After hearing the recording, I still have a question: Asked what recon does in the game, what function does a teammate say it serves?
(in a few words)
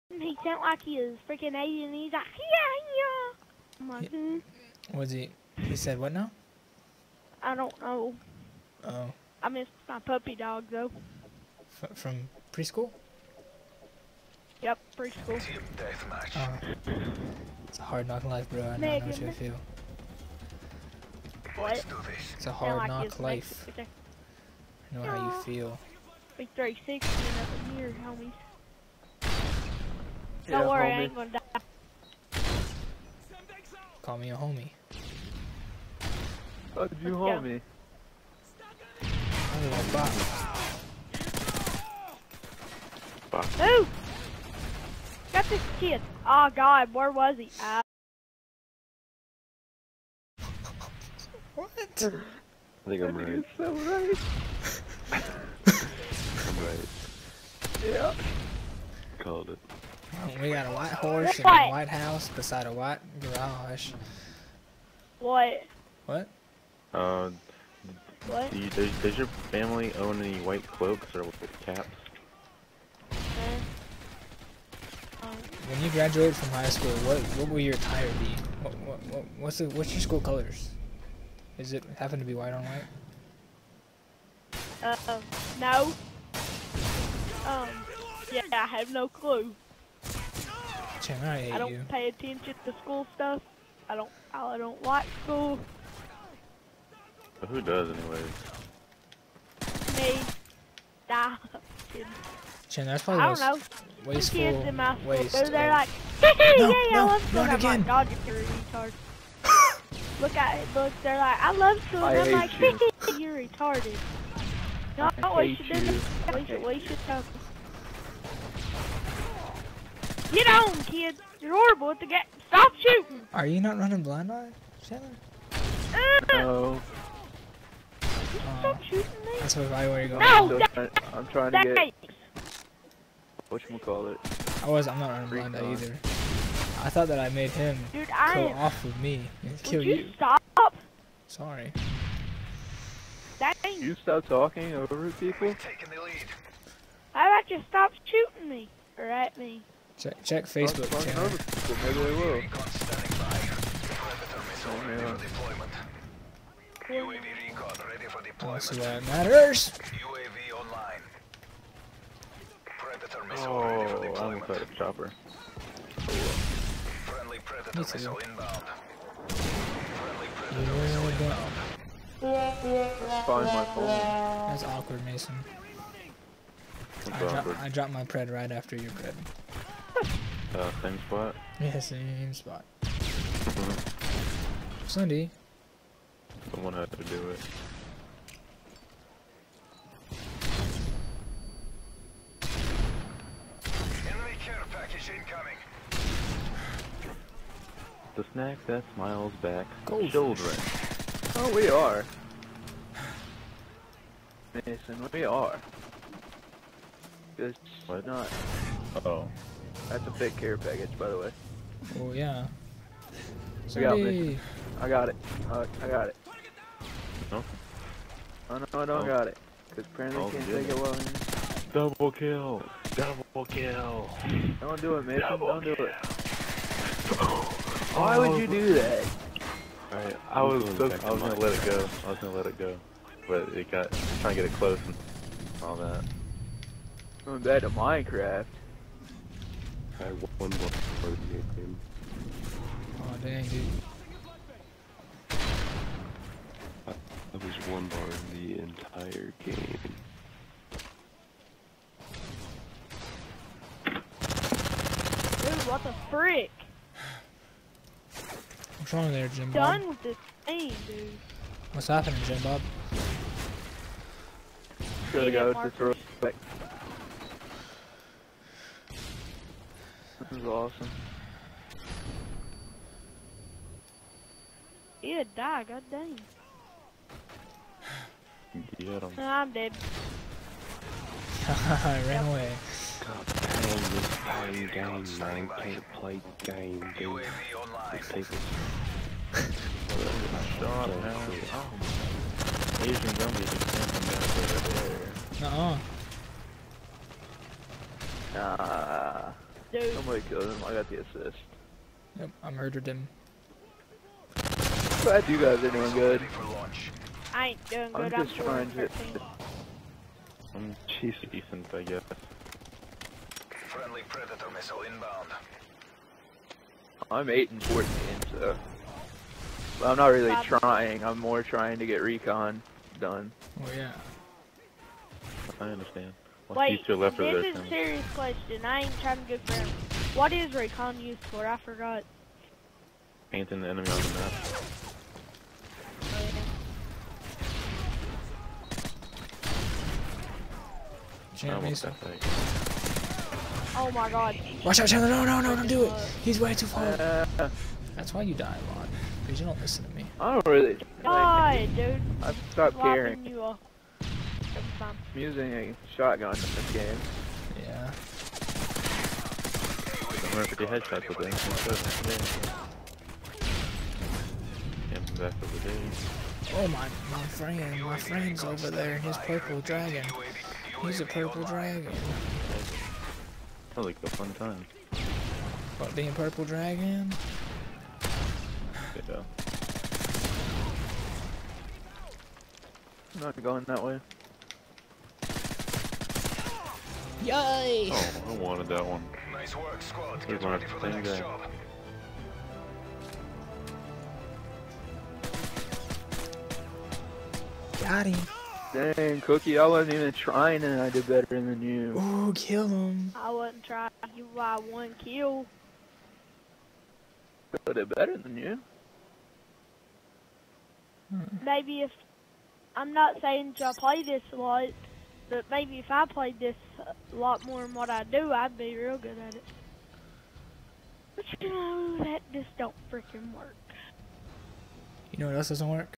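painting the enemy on the map.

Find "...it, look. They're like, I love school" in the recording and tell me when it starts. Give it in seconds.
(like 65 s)
110 s.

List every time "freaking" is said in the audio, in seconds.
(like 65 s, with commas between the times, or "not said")
1 s, 422 s.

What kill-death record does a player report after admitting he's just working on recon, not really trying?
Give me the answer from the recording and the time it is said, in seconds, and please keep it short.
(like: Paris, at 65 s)
8 and 14, at 317 s.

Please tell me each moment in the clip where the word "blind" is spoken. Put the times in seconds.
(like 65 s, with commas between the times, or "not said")
124 s, 135 s.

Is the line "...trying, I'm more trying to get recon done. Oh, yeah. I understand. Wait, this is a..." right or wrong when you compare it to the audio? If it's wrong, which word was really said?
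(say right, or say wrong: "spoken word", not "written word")
right.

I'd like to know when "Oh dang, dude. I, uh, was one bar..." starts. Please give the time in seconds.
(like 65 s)
243 s.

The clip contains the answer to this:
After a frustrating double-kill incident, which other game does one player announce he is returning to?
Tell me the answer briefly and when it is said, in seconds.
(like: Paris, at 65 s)
Minecraft, at 237 s.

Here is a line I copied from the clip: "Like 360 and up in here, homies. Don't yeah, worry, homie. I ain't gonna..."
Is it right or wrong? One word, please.
right.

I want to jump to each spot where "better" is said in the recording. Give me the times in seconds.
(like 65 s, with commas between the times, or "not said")
401 s, 407 s.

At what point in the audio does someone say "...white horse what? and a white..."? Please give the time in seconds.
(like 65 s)
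60 s.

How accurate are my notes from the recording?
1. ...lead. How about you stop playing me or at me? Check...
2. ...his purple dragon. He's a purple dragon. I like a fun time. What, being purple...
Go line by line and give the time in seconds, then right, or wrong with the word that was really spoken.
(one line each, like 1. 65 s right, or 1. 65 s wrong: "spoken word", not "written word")
1. 146 s wrong: "shooting", not "playing"
2. 368 s right.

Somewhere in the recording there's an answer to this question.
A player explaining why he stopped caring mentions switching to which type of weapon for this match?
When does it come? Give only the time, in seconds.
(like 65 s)
355 s.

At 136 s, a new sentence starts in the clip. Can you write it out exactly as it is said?
I thought that I made him Dude, I go am...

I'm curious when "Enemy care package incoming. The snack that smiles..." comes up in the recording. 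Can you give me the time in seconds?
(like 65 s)
194 s.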